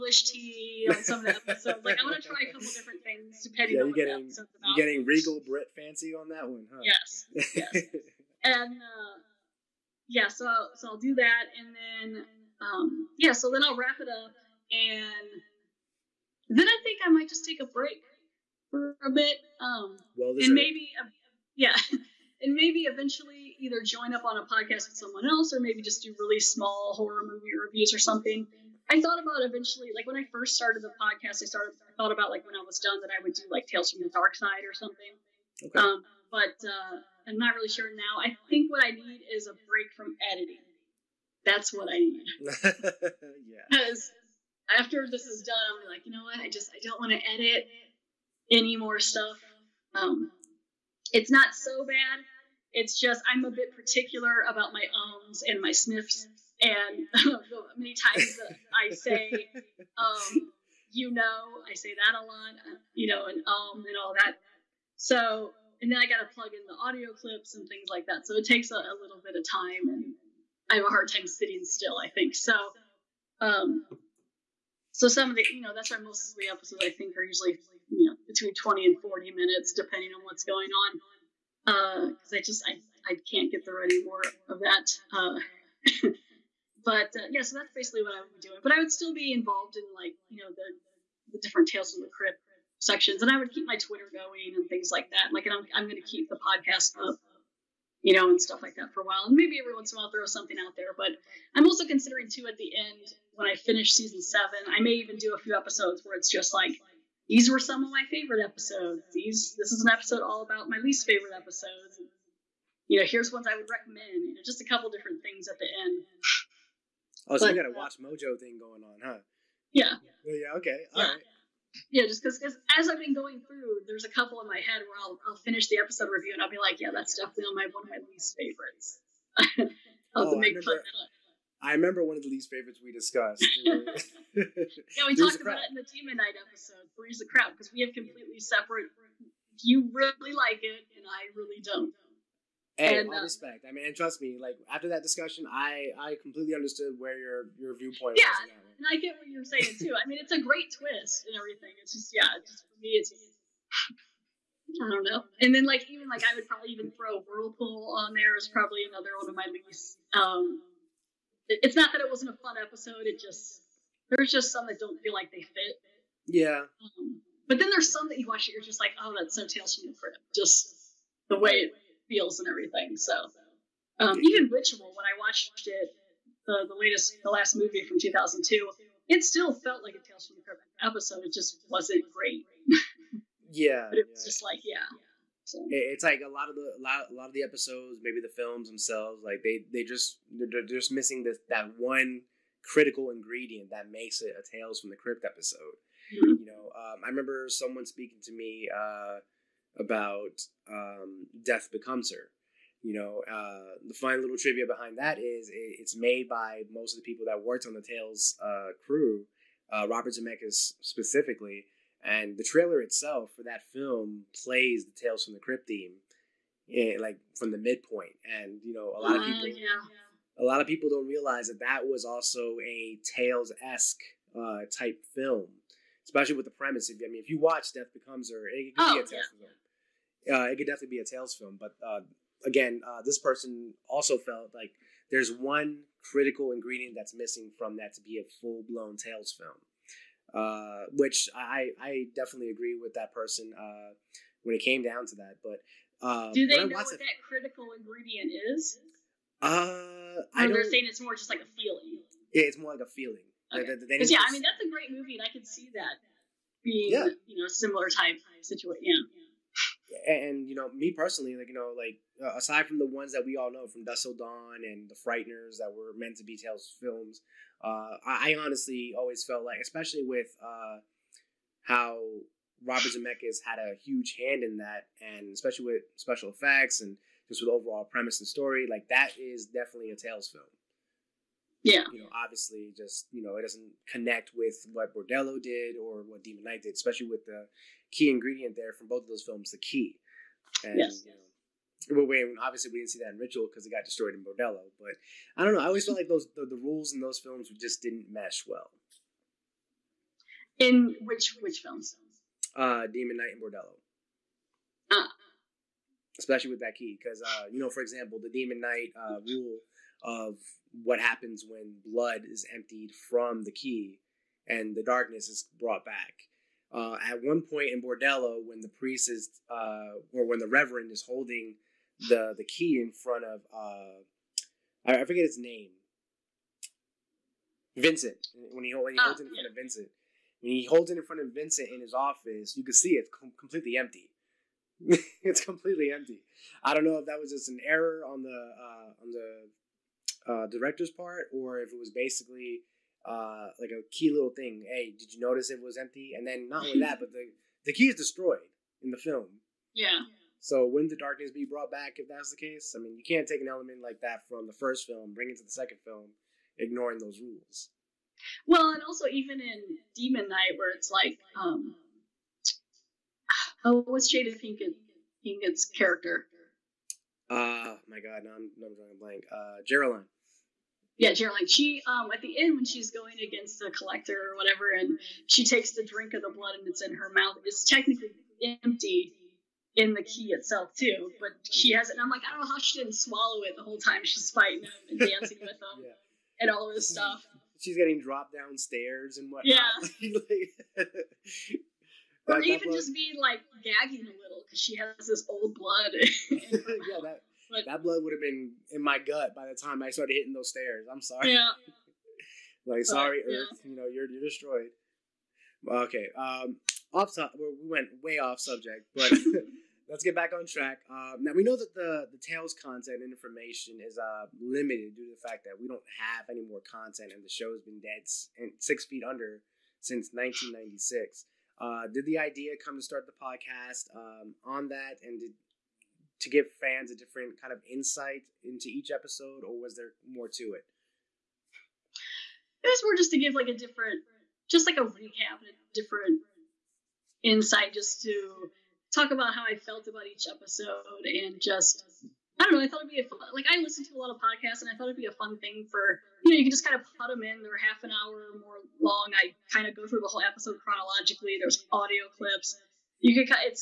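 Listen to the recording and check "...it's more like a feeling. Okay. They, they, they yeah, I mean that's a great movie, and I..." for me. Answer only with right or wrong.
right.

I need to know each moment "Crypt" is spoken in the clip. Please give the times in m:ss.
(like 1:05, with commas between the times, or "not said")
1:32, 2:49, 3:00, 3:14, 3:35.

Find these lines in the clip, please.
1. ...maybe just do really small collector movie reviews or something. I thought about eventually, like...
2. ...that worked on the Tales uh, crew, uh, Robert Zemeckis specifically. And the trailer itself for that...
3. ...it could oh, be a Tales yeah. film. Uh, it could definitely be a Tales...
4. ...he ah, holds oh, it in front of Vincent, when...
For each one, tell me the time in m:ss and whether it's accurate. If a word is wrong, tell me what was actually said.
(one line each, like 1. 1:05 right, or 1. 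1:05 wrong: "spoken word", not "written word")
1. 0:25 wrong: "horror", not "collector"
2. 3:27 right
3. 3:48 right
4. 5:28 right.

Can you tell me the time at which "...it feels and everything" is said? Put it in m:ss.
2:51.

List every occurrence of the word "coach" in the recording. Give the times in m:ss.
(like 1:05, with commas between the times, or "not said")
not said.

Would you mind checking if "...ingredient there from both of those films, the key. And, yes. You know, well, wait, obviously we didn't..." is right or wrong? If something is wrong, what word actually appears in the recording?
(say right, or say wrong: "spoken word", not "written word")
right.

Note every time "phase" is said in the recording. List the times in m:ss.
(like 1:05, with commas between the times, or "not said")
not said.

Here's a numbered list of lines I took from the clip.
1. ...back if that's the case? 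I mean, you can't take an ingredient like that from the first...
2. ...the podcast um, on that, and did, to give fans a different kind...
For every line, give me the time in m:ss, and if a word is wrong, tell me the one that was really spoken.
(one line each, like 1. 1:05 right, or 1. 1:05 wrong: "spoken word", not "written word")
1. 5:51 wrong: "element", not "ingredient"
2. 7:03 right.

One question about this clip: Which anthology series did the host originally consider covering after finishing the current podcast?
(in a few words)
Tales from the Dark Side.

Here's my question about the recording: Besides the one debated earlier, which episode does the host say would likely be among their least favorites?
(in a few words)
Whirlpool.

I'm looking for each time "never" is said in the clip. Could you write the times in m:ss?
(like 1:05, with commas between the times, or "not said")
not said.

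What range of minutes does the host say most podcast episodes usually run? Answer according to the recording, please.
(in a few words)
20 to 40 minutes.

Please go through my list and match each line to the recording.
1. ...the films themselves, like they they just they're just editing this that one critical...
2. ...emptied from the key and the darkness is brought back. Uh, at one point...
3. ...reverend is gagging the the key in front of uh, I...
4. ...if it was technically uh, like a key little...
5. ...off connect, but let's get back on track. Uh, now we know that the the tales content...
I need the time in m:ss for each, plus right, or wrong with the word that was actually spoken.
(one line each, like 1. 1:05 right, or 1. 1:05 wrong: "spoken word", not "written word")
1. 3:08 wrong: "missing", not "editing"
2. 5:12 right
3. 5:20 wrong: "holding", not "gagging"
4. 5:41 wrong: "basically", not "technically"
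5. 6:48 wrong: "subject", not "connect".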